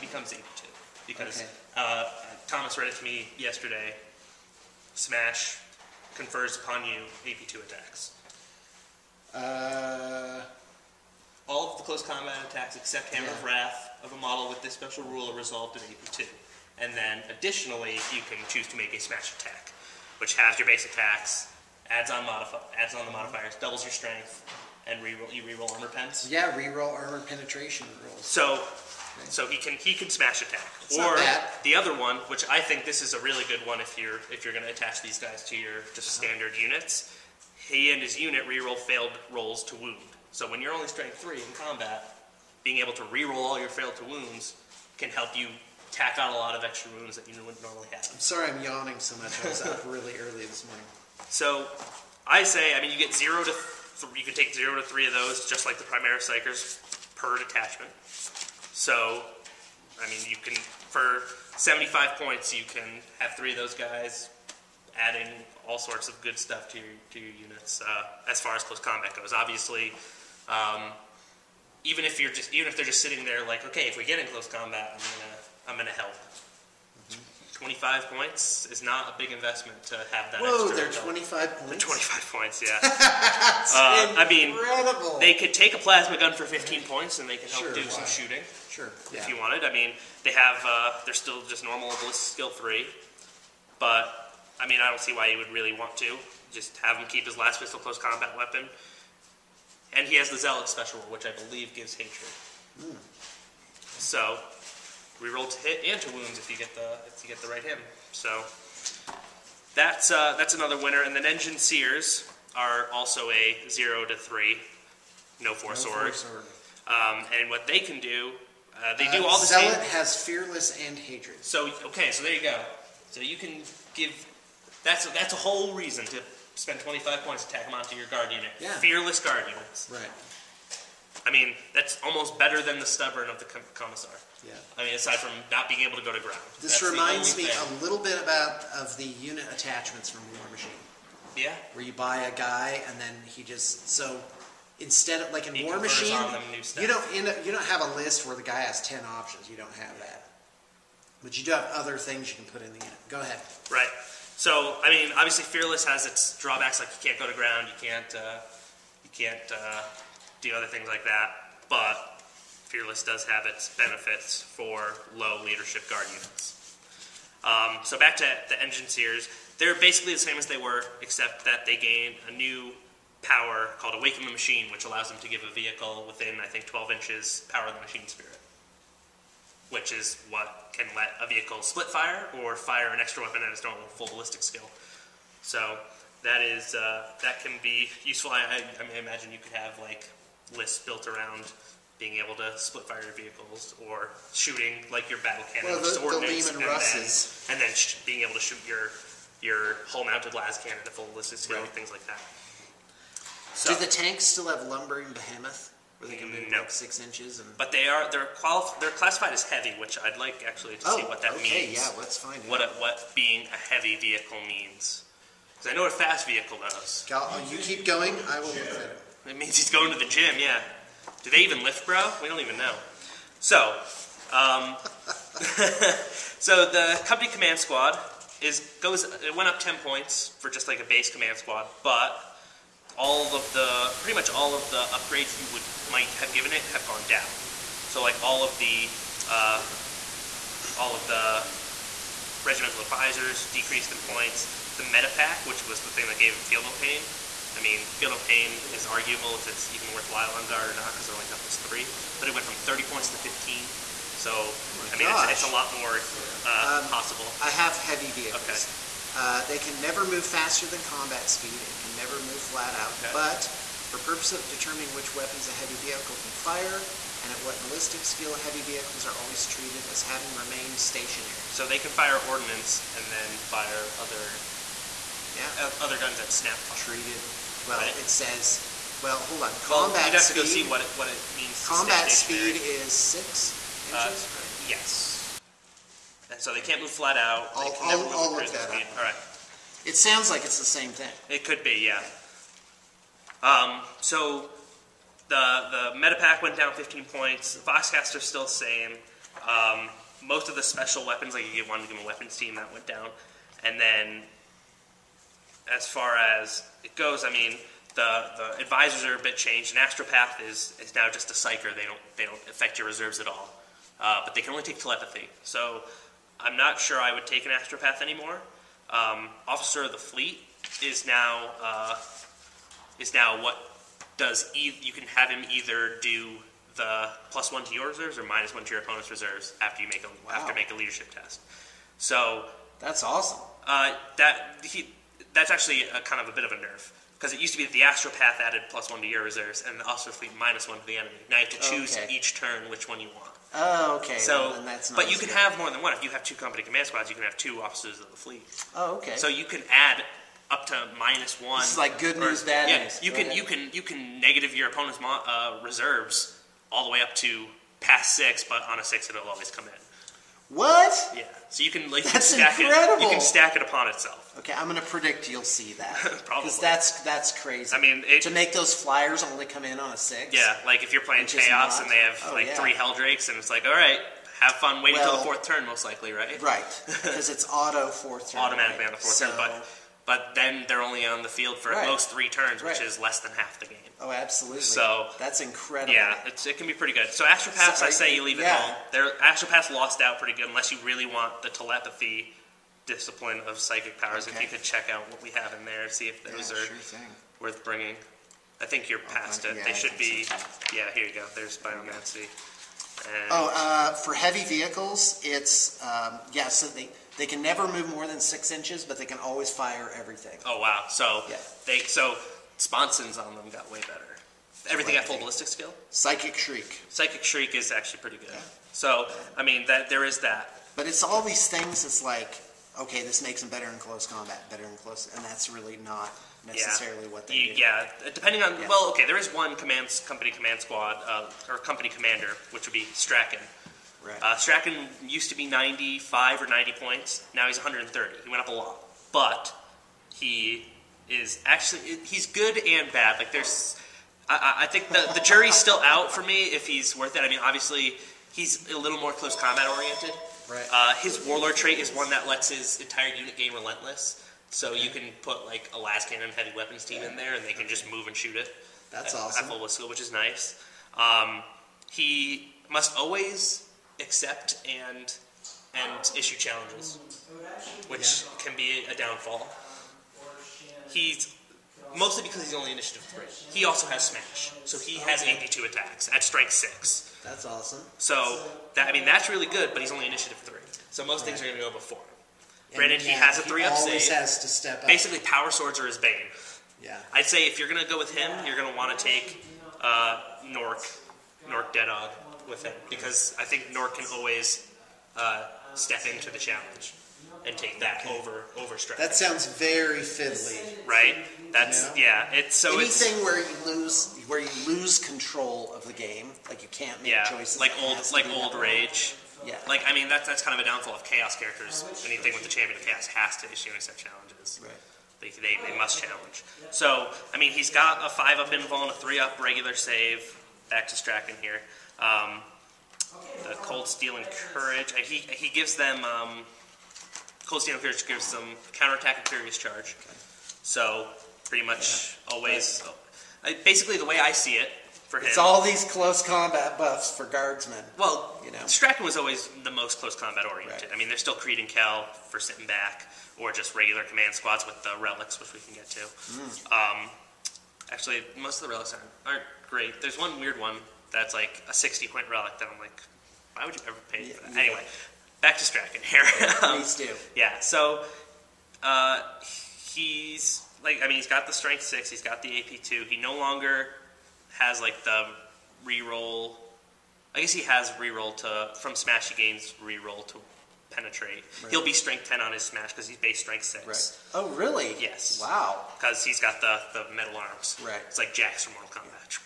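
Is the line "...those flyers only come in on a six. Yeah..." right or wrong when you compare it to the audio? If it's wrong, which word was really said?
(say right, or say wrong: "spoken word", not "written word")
right.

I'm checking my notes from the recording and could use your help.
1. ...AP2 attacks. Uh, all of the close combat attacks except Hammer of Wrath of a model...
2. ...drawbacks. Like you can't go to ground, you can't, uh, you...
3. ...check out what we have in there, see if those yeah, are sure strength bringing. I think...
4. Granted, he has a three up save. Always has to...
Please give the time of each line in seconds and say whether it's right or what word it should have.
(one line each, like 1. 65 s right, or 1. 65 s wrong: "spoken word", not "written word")
1. 7 s right
2. 156 s right
3. 394 s wrong: "worth", not "strength"
4. 482 s right.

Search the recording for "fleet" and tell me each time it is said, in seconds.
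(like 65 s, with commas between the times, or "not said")
319 s, 340 s, 348 s.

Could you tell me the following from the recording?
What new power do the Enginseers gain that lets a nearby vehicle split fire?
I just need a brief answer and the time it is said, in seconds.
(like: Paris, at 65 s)
Awaken the Machine, at 173 s.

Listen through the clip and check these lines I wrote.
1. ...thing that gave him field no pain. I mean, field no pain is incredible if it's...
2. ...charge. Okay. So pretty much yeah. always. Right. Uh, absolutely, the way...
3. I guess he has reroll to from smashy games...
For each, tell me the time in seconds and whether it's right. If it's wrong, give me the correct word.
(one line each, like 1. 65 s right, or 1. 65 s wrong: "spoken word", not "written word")
1. 245 s wrong: "arguable", not "incredible"
2. 529 s wrong: "basically", not "absolutely"
3. 567 s right.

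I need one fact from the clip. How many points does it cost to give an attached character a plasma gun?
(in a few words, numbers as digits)
15 points.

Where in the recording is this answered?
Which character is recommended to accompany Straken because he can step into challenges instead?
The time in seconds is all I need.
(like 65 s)
491 s.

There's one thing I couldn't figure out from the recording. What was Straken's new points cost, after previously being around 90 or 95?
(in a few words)
130.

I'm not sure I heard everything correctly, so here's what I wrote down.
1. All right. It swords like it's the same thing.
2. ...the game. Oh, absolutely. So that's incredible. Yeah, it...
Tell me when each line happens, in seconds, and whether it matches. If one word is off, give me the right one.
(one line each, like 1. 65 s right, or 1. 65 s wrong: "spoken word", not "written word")
1. 288 s wrong: "sounds", not "swords"
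2. 383 s right.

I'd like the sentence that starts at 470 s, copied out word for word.
He's mostly because he's only initiative three.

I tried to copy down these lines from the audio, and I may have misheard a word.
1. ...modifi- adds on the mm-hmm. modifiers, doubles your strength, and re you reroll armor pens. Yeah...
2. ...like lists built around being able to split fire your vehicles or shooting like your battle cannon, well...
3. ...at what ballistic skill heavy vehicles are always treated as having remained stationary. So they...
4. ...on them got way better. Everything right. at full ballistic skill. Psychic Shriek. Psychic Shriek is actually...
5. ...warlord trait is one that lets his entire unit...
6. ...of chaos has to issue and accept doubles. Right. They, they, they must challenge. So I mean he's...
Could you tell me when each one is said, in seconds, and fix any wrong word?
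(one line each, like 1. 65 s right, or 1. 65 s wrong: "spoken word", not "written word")
1. 22 s right
2. 189 s right
3. 267 s right
4. 413 s right
5. 451 s right
6. 512 s wrong: "challenges", not "doubles".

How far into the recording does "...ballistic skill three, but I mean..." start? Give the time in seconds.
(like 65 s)
91 s.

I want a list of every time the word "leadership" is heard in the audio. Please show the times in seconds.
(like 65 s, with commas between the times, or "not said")
165 s, 330 s.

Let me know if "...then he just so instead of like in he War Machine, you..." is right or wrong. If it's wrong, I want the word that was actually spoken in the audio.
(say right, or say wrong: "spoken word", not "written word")
right.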